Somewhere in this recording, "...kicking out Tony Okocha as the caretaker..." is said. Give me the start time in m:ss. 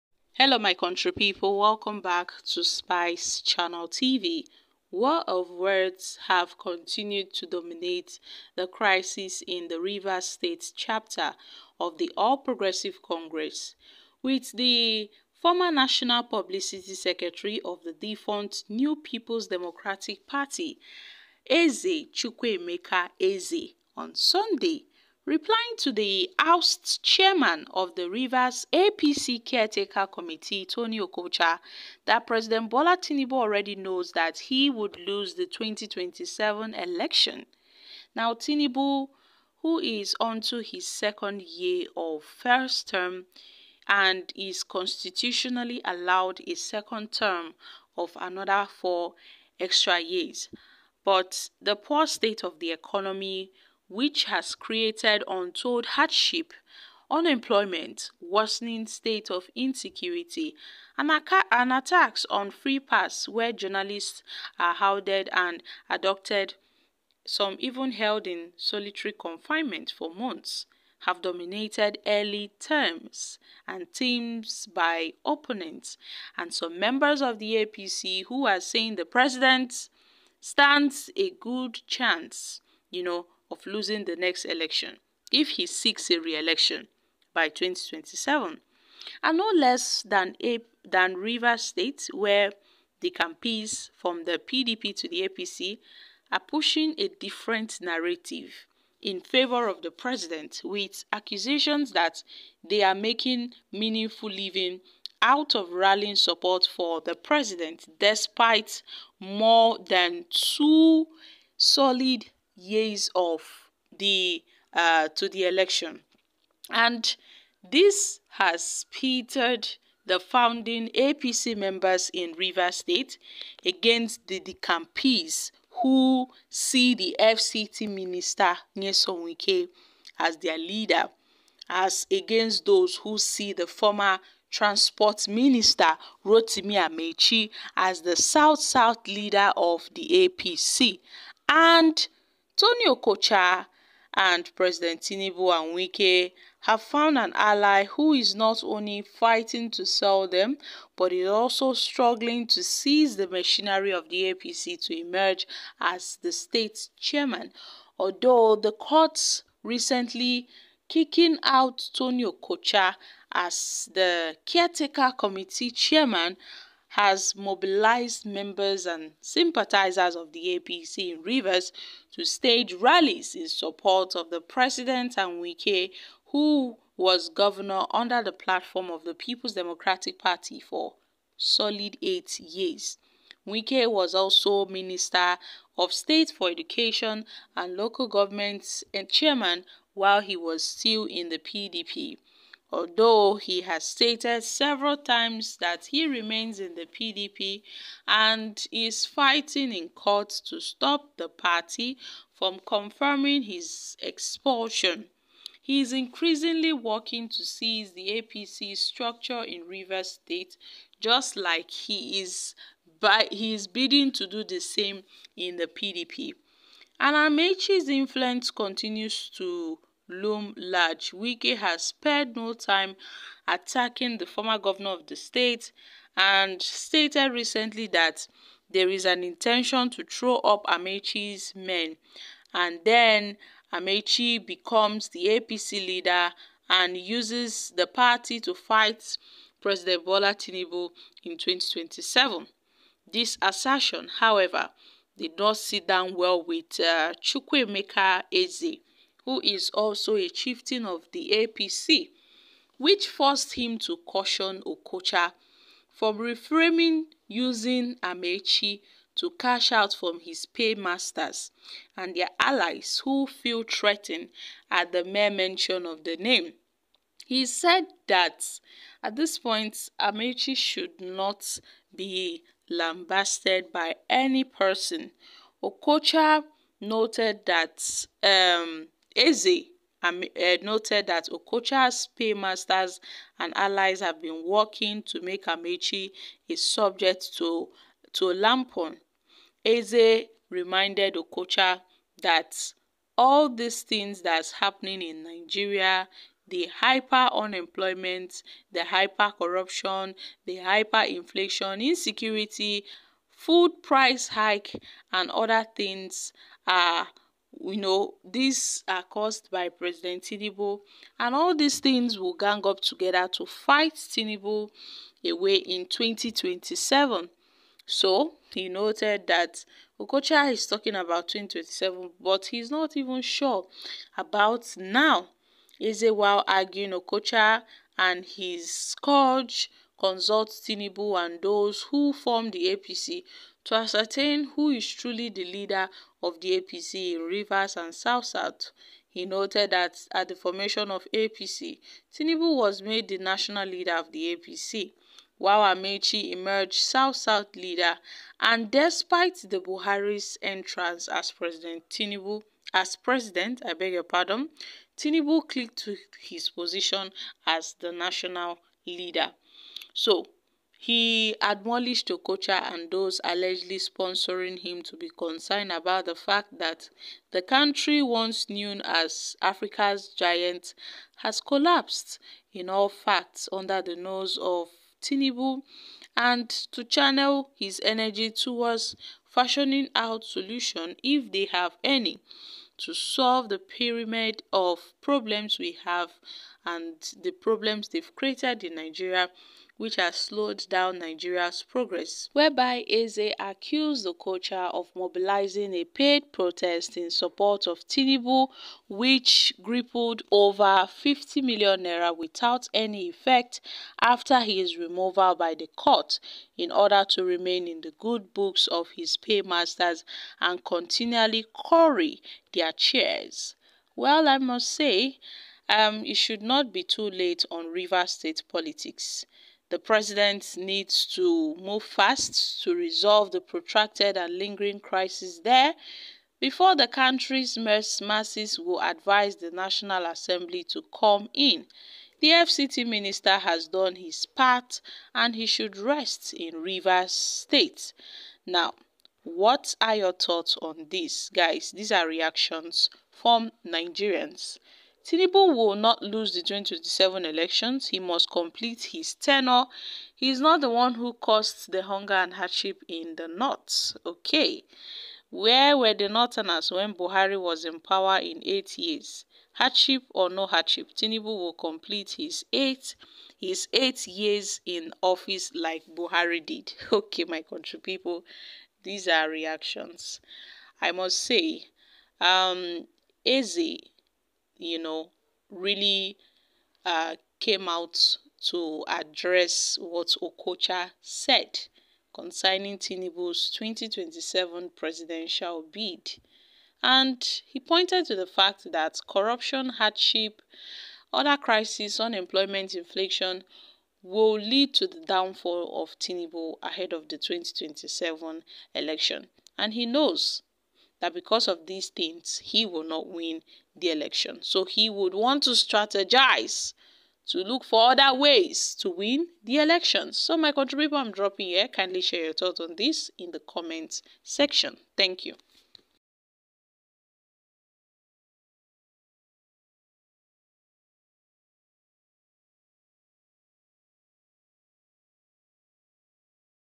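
2:40.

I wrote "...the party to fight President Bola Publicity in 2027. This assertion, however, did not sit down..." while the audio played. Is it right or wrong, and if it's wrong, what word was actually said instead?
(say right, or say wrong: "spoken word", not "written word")
wrong: "Tinubu", not "Publicity".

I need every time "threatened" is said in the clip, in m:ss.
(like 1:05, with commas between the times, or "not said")
4:23.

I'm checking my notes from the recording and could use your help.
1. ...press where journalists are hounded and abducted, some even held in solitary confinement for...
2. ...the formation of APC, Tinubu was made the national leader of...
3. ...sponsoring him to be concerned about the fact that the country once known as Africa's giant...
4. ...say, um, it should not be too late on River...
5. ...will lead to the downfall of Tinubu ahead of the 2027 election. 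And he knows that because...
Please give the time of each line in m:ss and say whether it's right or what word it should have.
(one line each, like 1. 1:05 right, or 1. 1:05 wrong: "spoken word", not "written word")
1. 1:02 right
2. 5:40 right
3. 6:03 right
4. 6:54 right
5. 8:14 right.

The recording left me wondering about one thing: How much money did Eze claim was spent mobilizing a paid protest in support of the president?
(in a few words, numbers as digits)
50 million naira.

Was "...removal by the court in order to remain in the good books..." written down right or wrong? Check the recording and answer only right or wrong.
right.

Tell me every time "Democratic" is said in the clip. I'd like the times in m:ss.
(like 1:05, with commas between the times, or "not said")
0:19, 2:59.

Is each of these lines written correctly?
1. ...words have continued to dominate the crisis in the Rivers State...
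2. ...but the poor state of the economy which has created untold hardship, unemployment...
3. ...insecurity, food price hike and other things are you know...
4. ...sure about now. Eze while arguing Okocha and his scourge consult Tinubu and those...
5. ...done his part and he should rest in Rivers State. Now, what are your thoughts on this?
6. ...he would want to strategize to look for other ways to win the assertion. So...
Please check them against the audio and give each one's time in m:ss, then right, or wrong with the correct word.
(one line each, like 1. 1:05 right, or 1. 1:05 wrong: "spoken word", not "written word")
1. 0:05 right
2. 0:51 right
3. 5:01 right
4. 5:23 right
5. 7:13 right
6. 8:24 wrong: "election", not "assertion".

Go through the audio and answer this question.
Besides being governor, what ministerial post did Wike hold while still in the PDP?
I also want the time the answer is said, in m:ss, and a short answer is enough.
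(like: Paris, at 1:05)
Minister of State for Education, at 3:04.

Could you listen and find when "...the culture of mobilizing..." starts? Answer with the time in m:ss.
6:34.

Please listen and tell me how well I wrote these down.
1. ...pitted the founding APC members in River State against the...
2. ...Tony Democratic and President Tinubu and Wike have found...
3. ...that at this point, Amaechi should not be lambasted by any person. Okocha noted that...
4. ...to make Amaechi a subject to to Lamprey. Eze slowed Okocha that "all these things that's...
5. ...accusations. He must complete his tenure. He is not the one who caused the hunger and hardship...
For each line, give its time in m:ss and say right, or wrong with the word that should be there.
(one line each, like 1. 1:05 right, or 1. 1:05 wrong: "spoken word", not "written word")
1. 1:58 right
2. 2:22 wrong: "Okocha", not "Democratic"
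3. 4:28 right
4. 4:45 wrong: "reminded", not "slowed"
5. 7:27 wrong: "elections", not "accusations".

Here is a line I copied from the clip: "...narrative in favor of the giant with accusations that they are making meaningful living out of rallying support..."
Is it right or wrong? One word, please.
wrong.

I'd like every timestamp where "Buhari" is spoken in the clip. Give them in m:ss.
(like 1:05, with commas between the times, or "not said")
5:49, 7:36, 7:45.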